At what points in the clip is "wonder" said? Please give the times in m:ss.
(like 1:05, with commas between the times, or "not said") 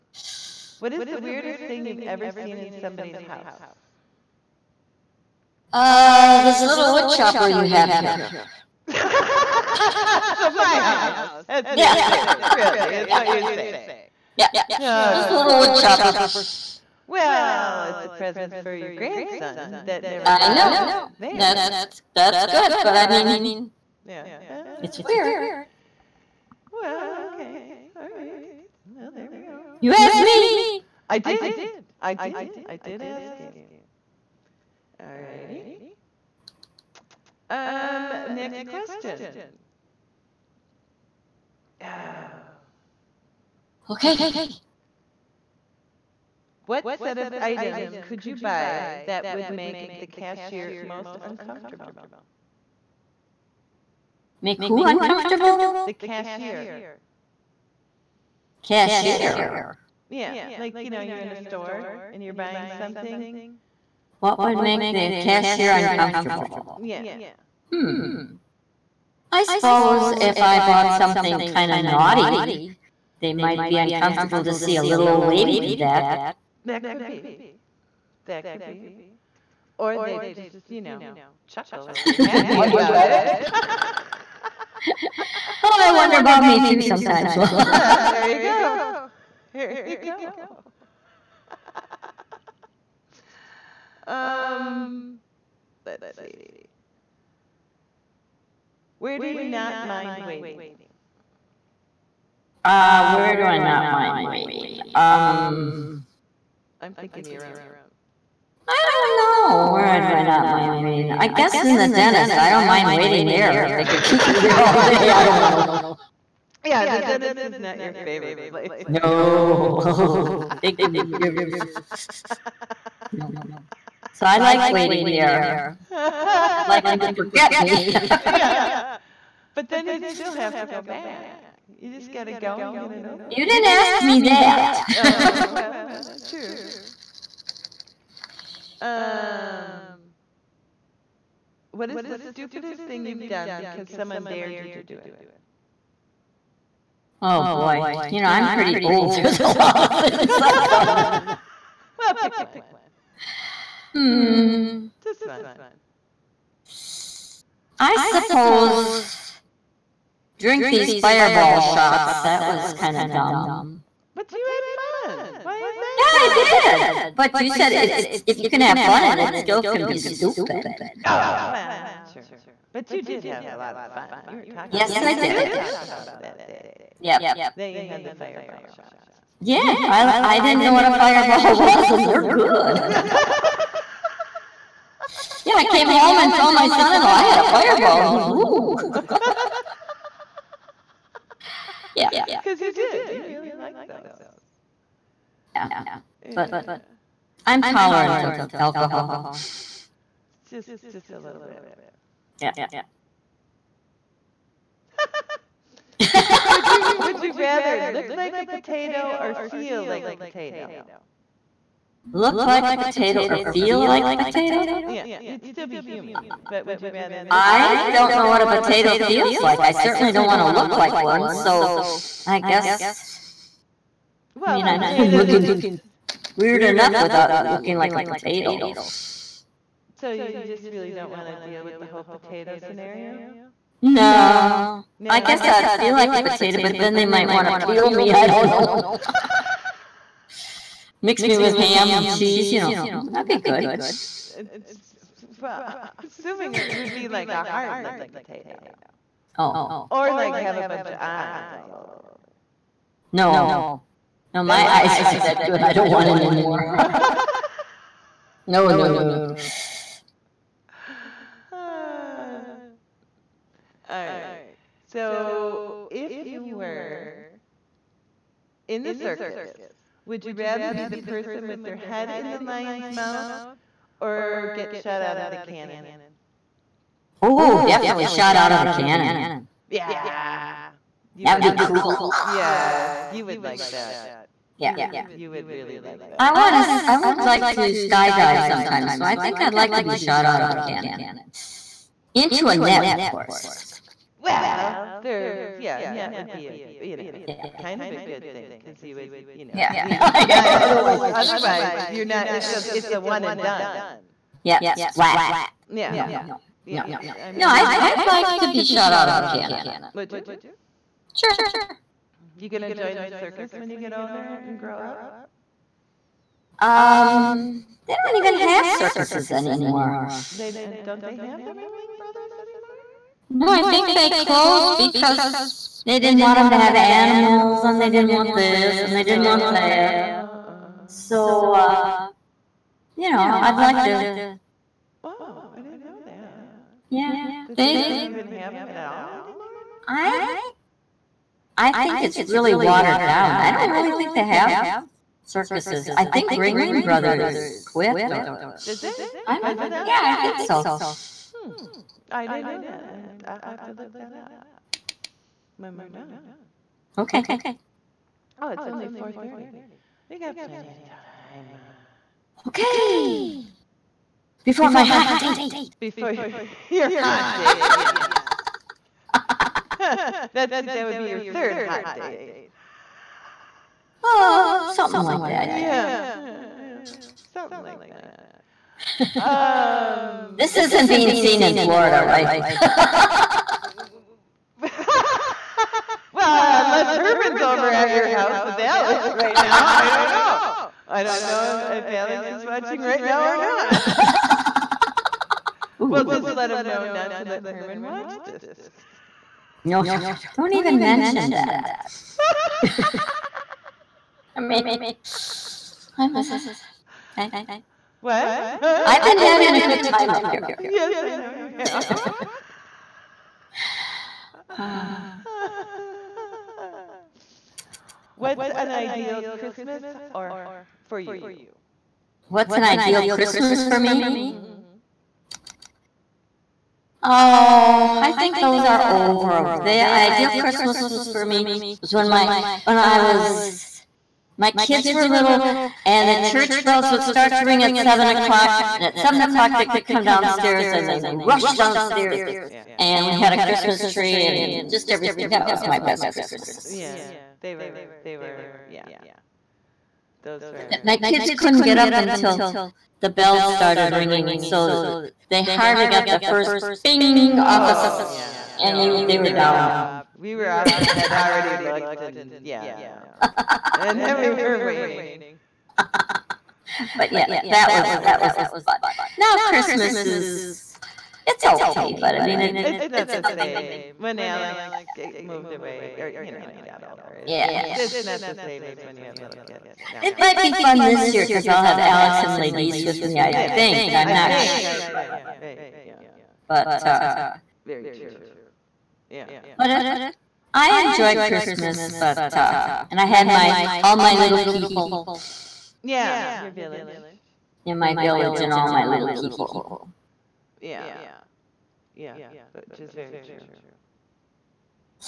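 1:25.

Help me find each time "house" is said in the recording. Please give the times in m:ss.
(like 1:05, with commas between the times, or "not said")
0:03, 0:10, 6:28.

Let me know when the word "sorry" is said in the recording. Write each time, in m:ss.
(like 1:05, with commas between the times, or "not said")
not said.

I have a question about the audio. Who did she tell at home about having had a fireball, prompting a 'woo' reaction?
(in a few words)
son-in-law.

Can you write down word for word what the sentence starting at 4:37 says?
Oh, definitely shot out of the cannon.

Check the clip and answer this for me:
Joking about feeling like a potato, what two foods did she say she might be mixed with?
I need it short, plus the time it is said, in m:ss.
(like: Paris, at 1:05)
ham and cheese, at 4:01.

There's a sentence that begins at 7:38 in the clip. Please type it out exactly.
And no, you, they we were, were down.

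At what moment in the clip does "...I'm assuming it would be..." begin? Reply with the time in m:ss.
4:05.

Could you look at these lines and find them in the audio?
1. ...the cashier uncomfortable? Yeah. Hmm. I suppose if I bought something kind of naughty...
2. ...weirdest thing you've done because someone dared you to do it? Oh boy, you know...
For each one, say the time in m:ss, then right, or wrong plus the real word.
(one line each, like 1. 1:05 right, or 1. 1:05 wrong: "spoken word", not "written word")
1. 1:04 right
2. 2:22 wrong: "stupidest", not "weirdest".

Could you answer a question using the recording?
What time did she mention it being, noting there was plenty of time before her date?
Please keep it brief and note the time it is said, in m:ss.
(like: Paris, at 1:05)
4.30, at 5:58.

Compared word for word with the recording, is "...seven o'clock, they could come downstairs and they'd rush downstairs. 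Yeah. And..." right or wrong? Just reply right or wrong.
right.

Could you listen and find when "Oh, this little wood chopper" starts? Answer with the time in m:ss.
0:14.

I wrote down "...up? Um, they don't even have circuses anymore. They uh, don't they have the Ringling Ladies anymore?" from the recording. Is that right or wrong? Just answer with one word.
wrong.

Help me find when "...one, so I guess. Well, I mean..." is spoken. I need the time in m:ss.
3:40.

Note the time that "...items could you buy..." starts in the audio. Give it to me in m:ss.
0:47.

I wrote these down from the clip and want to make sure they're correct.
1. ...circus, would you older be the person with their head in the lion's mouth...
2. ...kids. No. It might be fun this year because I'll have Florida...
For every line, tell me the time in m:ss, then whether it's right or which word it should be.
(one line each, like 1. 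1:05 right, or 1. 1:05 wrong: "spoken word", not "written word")
1. 4:28 wrong: "rather", not "older"
2. 7:59 wrong: "Alex", not "Florida".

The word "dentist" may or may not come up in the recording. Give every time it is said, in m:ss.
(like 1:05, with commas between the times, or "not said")
1:51, 1:56.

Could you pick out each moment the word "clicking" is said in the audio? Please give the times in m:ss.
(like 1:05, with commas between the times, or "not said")
not said.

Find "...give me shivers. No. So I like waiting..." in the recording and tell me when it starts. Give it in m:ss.
2:00.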